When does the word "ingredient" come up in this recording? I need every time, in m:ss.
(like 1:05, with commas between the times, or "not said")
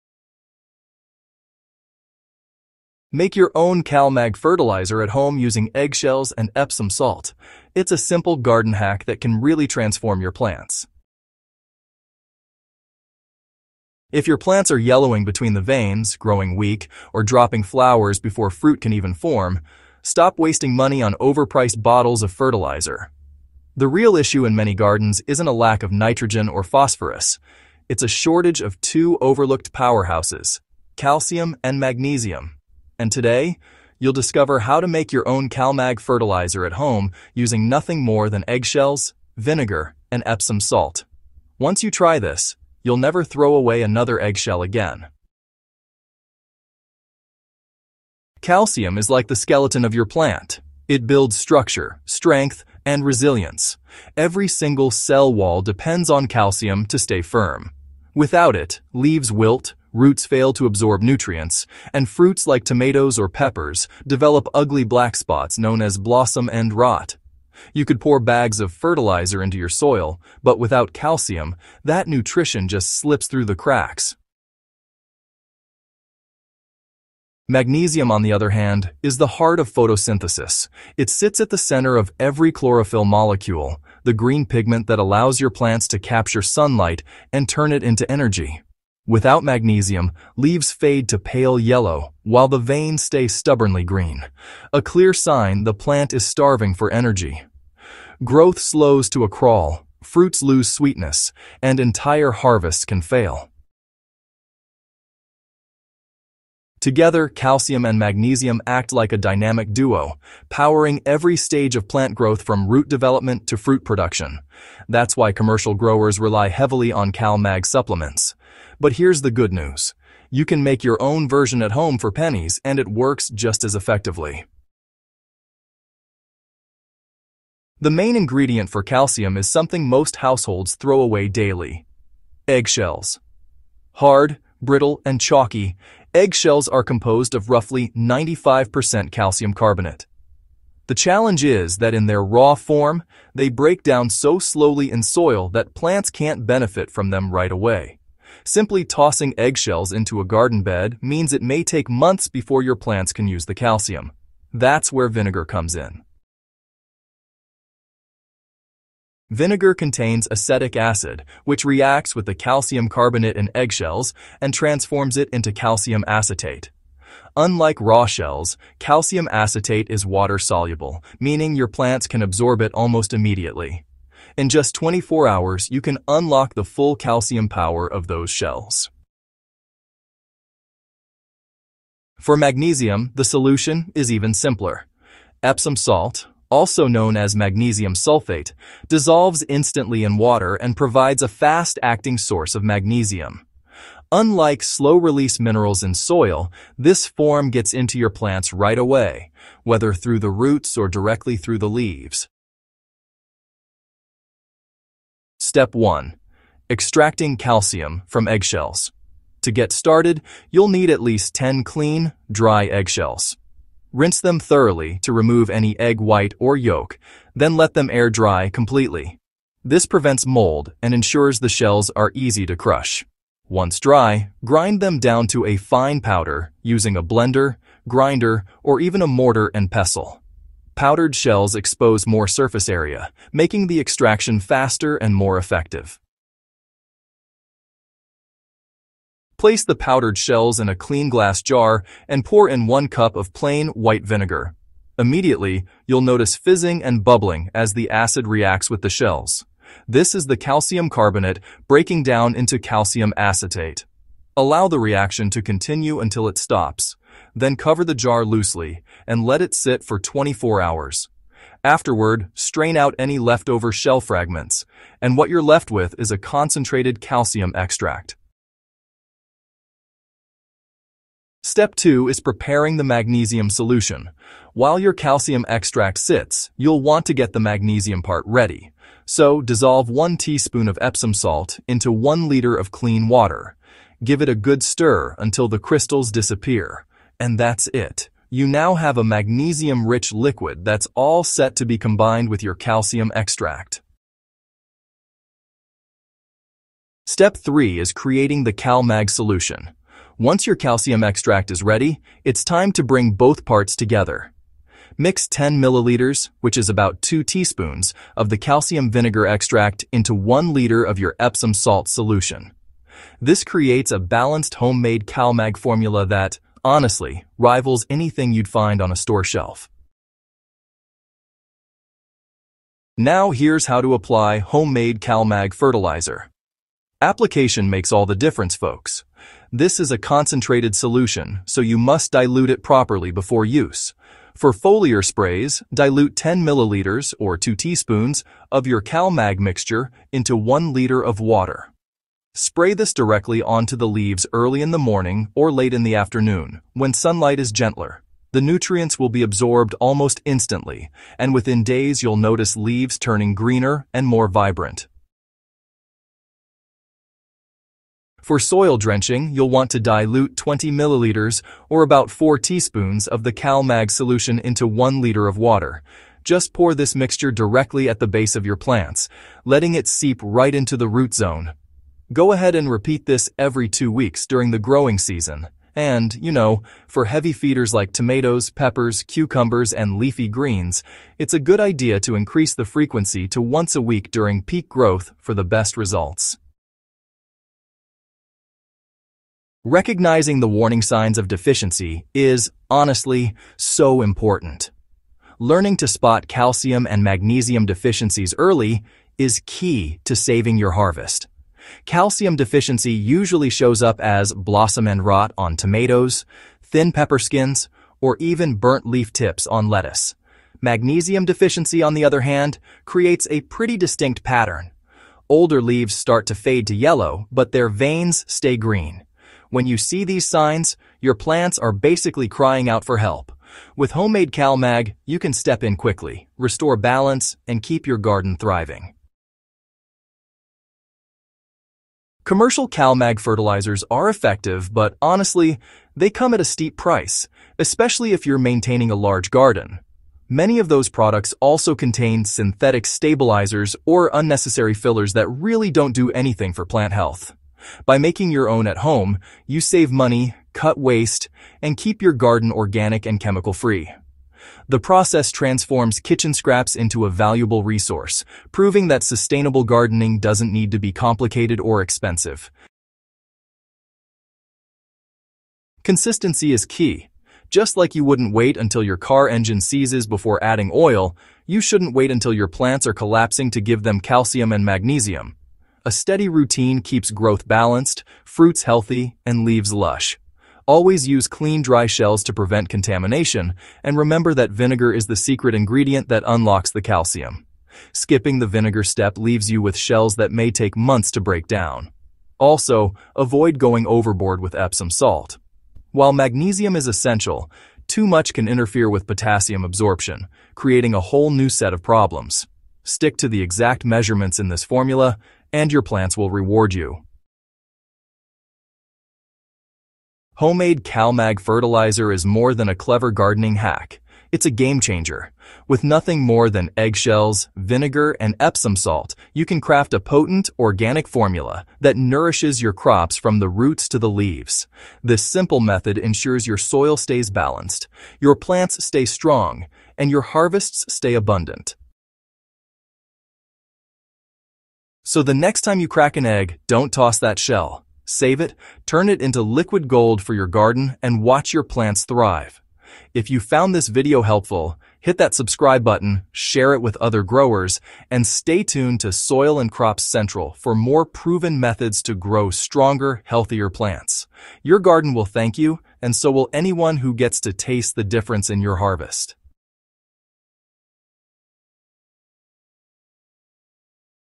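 2:08, 8:05.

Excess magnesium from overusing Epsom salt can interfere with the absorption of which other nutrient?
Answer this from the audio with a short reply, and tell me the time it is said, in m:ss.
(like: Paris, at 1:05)
potassium, at 8:19.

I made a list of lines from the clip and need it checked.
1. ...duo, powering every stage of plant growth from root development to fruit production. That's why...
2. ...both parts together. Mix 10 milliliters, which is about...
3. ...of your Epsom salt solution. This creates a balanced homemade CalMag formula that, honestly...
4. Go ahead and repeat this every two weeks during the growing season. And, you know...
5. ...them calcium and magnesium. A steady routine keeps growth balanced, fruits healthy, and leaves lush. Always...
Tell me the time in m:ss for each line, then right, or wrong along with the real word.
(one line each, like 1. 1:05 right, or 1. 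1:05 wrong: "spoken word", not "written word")
1. 1:49 right
2. 5:03 right
3. 5:10 right
4. 6:12 right
5. 7:53 right.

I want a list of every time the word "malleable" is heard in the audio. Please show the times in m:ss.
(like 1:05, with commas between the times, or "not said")
not said.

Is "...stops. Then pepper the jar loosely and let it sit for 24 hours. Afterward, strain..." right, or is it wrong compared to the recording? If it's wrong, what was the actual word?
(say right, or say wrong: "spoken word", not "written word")
wrong: "cover", not "pepper".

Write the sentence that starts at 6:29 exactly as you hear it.
Recognizing the warning signs of deficiency is, honestly, so important.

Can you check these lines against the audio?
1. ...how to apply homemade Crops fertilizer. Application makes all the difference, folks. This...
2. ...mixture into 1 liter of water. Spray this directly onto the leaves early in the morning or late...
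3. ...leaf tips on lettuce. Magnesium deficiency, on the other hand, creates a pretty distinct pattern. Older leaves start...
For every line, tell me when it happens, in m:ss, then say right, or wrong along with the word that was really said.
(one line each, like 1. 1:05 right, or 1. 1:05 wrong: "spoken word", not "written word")
1. 5:23 wrong: "CalMag", not "Crops"
2. 5:39 right
3. 6:48 right.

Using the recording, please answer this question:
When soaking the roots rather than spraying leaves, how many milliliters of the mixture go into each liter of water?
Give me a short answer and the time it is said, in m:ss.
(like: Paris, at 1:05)
20 milliliters, at 6:00.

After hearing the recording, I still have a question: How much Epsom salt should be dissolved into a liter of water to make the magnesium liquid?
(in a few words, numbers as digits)
1 teaspoon.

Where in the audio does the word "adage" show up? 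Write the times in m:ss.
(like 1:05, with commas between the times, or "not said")
not said.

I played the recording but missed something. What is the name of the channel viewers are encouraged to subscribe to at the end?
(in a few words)
Soil and Crops Central.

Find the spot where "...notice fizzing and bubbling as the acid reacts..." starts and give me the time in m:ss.
4:06.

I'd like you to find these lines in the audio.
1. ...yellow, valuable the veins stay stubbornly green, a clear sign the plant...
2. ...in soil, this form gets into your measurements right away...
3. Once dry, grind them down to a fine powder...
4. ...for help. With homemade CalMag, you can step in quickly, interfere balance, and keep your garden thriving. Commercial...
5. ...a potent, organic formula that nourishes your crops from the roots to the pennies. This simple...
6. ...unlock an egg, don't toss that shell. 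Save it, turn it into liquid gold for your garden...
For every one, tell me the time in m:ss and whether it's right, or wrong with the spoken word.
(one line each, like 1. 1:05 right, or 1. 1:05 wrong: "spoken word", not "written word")
1. 1:31 wrong: "while", not "valuable"
2. 3:15 wrong: "plants", not "measurements"
3. 3:43 right
4. 7:02 wrong: "restore", not "interfere"
5. 8:39 wrong: "leaves", not "pennies"
6. 8:55 wrong: "crack", not "unlock".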